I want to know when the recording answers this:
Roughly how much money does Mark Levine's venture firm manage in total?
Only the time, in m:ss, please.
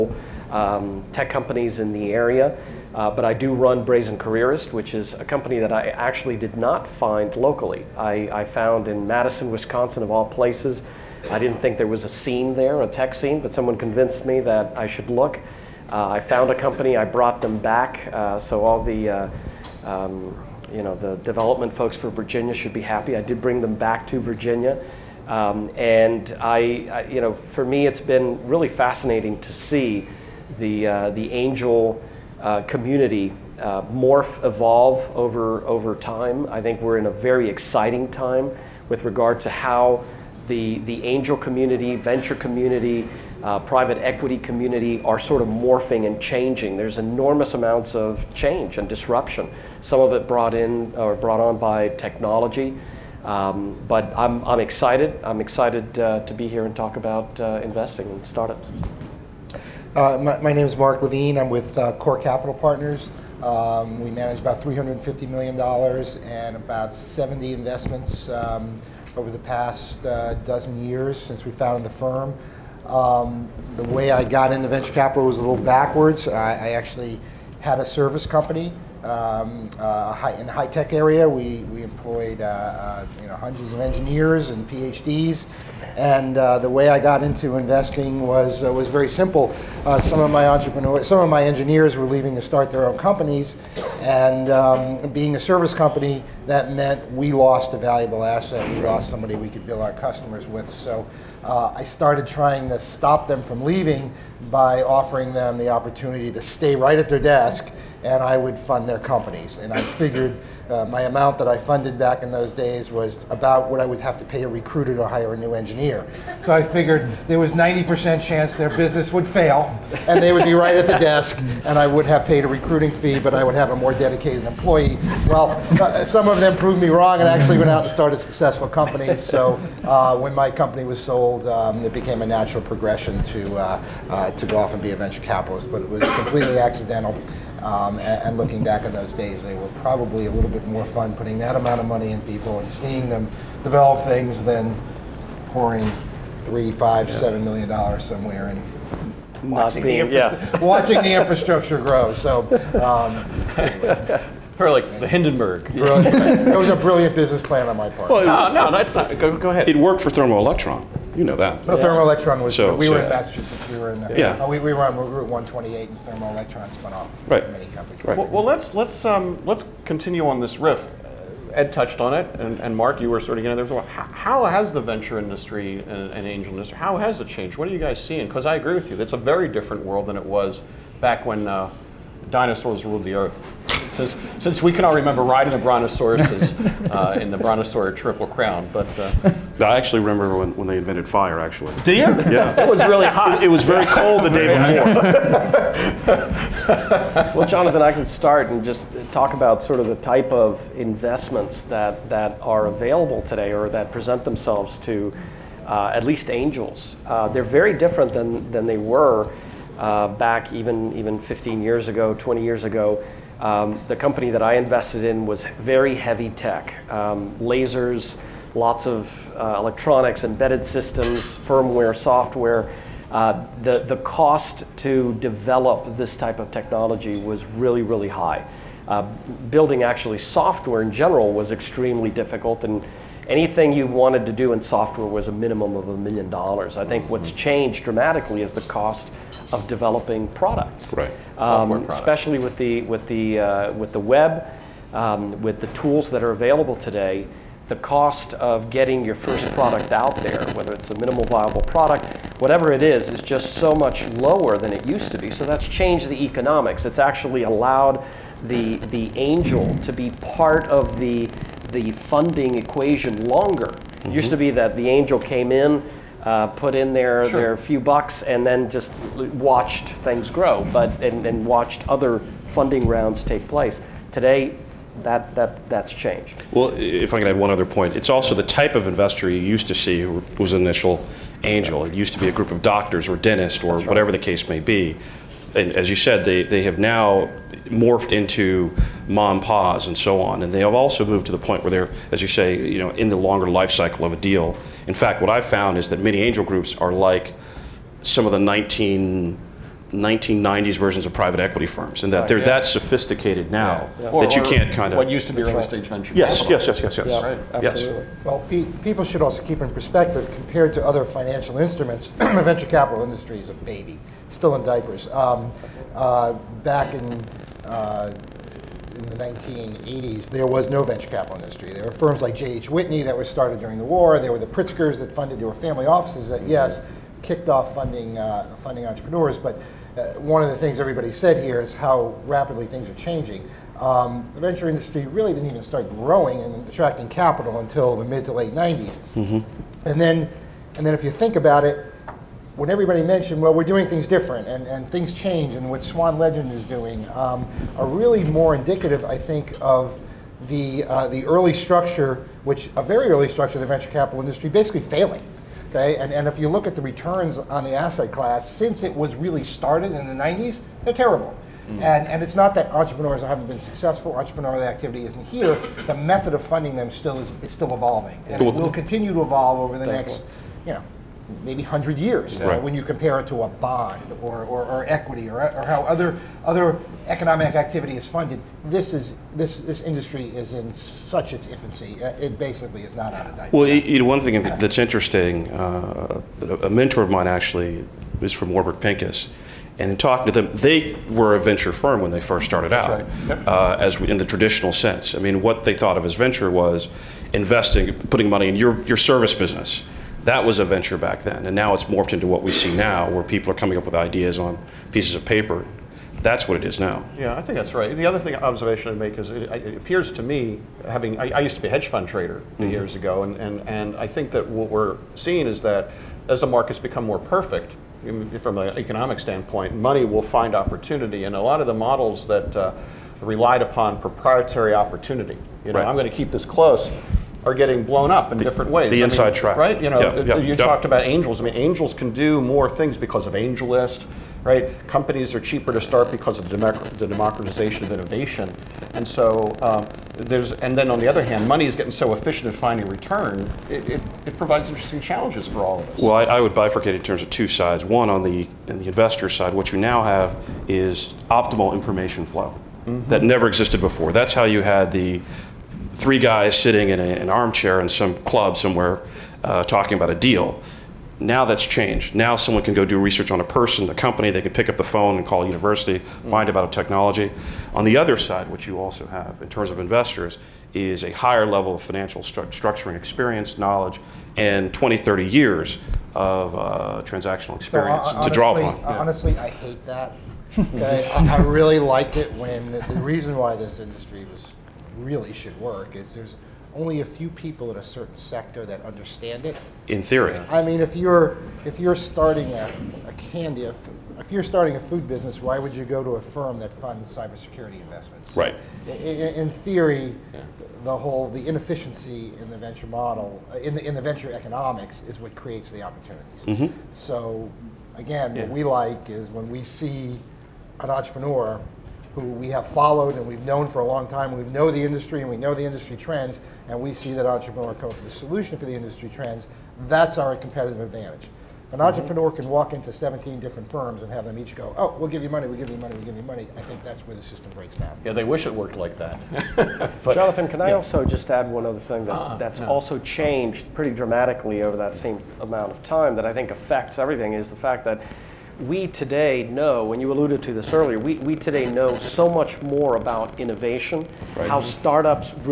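1:04.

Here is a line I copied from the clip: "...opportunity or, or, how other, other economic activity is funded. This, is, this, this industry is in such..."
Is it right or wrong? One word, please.
wrong.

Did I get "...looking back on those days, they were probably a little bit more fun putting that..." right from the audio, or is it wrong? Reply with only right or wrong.
right.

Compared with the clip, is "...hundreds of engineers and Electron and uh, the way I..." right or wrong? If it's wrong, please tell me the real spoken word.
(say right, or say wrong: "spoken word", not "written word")
wrong: "PhDs", not "Electron".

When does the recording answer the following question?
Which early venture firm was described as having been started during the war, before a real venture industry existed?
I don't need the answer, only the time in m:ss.
5:22.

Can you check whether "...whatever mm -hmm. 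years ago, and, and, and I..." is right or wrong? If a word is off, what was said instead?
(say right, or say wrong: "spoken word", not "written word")
wrong: "trader", not "whatever".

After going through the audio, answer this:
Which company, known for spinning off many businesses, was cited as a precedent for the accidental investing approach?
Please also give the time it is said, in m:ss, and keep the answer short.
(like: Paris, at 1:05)
Thermo Electron, at 2:40.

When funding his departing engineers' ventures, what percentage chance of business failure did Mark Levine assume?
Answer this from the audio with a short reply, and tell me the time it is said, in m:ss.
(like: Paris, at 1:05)
90%, at 1:57.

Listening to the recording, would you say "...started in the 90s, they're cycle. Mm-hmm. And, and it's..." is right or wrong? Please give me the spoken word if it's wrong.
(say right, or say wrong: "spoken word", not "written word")
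wrong: "terrible", not "cycle".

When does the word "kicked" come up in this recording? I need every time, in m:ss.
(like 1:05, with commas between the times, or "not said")
5:27.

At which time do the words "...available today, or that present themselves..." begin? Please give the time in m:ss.
3:22.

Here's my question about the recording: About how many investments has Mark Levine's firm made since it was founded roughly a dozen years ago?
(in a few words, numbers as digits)
70.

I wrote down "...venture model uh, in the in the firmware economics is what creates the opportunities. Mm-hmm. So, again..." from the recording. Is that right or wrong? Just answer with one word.
wrong.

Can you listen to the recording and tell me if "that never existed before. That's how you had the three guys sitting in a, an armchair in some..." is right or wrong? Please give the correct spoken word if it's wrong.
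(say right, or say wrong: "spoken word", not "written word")
right.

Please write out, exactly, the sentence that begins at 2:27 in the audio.
seven million dollars somewhere and watching, being, the yeah.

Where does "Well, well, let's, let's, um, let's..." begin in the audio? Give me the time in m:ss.
2:48.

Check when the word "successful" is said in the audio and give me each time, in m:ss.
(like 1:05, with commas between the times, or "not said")
2:08, 6:03.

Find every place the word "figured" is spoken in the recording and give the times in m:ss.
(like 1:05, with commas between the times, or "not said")
1:49, 1:56.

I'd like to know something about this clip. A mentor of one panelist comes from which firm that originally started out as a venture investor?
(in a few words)
Warburg Pincus.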